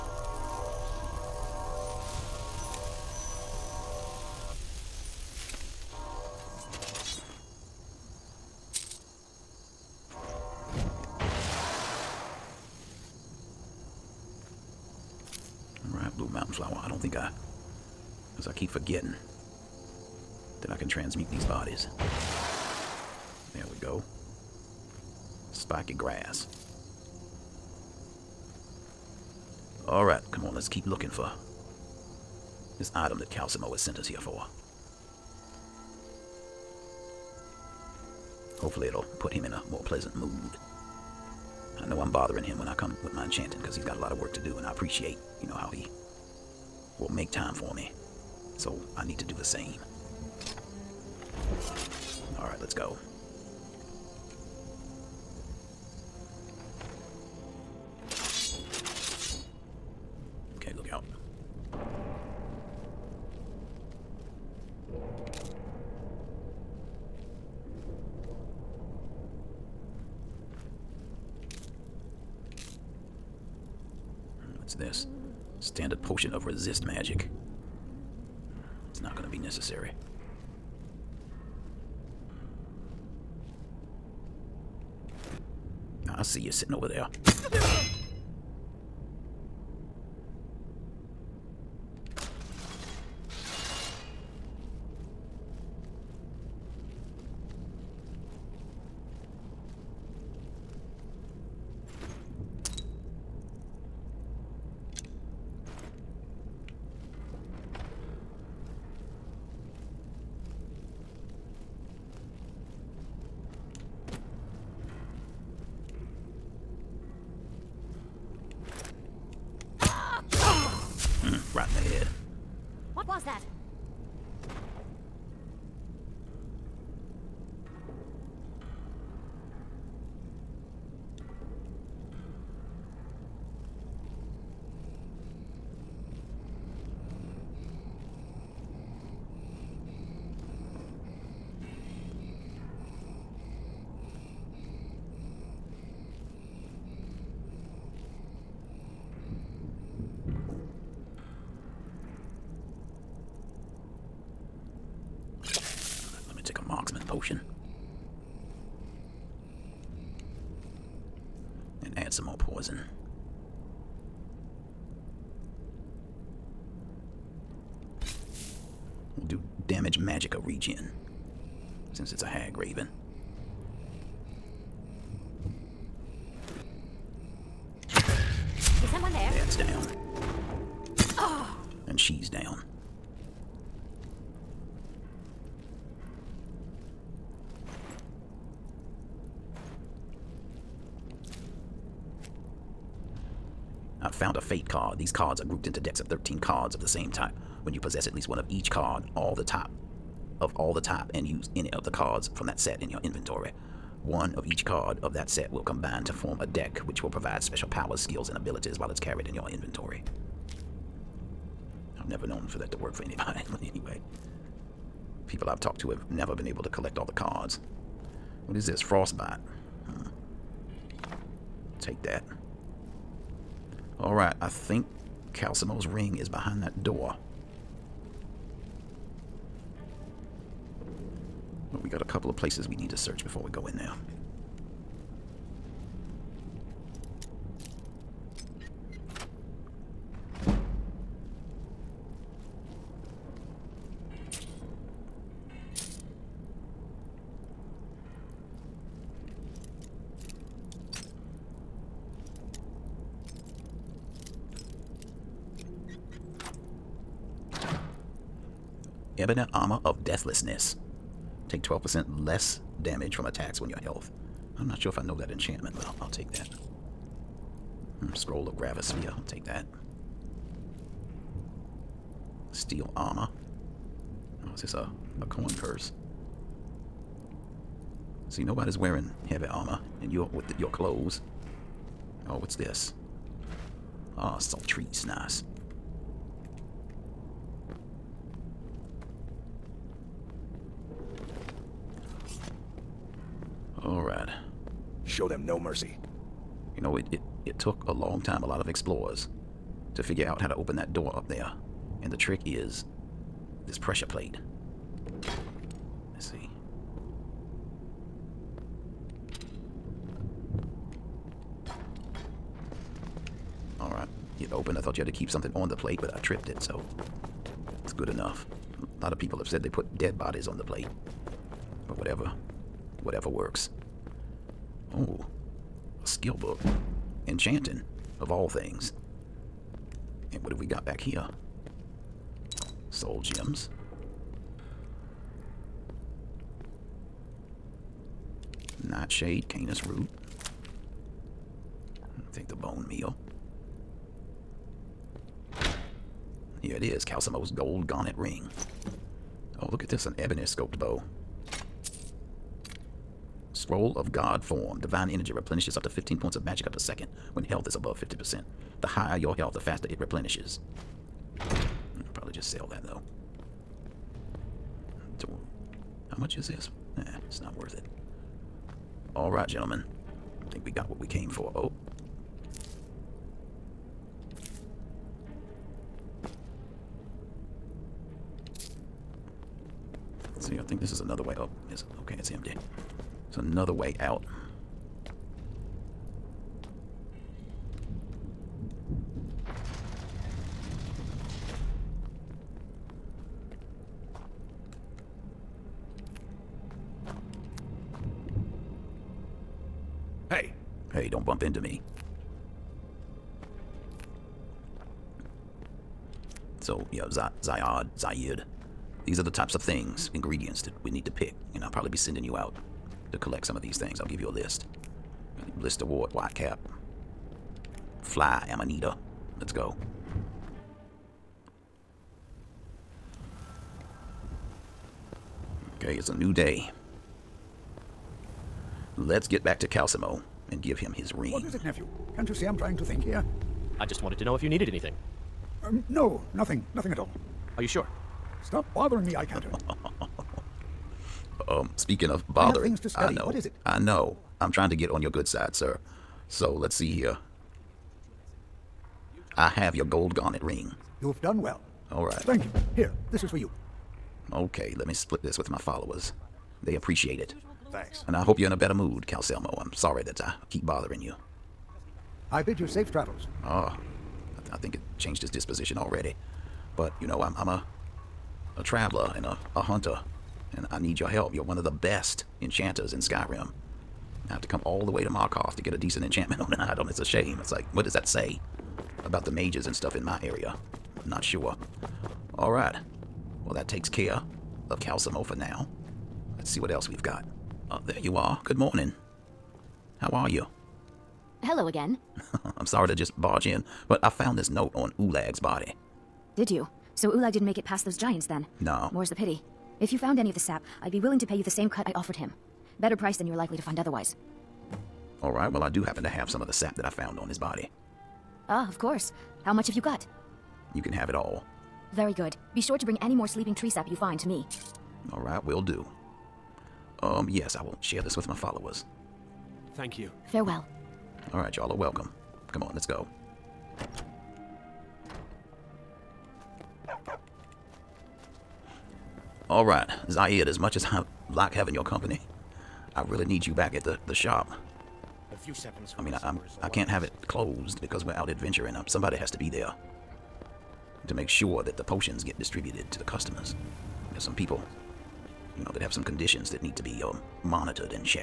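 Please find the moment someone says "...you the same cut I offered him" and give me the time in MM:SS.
08:21.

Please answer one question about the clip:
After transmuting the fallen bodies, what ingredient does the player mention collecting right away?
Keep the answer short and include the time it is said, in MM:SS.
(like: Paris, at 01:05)
Spiky grass, at 00:25.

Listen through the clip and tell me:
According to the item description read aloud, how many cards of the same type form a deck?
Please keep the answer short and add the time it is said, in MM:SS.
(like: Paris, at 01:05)
13, at 03:16.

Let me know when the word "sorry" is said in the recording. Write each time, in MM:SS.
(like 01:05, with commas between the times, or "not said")
07:39, 08:12.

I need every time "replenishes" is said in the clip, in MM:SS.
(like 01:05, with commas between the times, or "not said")
05:55, 05:59.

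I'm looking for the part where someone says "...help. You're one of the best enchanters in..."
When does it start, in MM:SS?
07:51.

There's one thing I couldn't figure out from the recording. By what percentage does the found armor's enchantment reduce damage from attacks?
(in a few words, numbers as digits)
12%.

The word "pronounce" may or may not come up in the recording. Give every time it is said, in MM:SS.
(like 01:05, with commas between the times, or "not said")
not said.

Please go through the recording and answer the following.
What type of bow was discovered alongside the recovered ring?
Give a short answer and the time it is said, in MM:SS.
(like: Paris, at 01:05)
Ebony scoped bow, at 05:50.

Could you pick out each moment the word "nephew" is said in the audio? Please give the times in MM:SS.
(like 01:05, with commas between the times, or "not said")
07:11.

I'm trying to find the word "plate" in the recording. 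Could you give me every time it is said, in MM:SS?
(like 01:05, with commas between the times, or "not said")
05:04, 05:15, 05:20.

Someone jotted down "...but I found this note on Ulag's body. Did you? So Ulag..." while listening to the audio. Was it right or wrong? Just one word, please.
right.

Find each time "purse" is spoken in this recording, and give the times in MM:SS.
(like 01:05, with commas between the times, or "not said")
04:35.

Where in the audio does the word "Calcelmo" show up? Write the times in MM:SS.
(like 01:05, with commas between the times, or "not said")
00:33, 03:45, 05:47, 07:09, 07:39, 08:04.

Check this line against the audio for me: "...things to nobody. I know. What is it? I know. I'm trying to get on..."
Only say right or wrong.
wrong.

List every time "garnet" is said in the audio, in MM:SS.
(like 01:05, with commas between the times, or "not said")
05:47, 07:30.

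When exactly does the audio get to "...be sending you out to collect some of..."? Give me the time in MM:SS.
06:51.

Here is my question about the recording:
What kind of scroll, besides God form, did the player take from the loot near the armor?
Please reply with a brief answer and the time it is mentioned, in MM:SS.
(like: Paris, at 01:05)
Gravisphere, at 04:28.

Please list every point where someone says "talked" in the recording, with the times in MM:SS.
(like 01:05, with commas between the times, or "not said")
03:35.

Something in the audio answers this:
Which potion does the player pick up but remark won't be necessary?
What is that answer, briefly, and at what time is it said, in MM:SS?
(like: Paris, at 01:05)
Potion of resist magic, at 01:16.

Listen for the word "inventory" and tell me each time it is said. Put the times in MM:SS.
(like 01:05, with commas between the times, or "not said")
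03:23, 03:29.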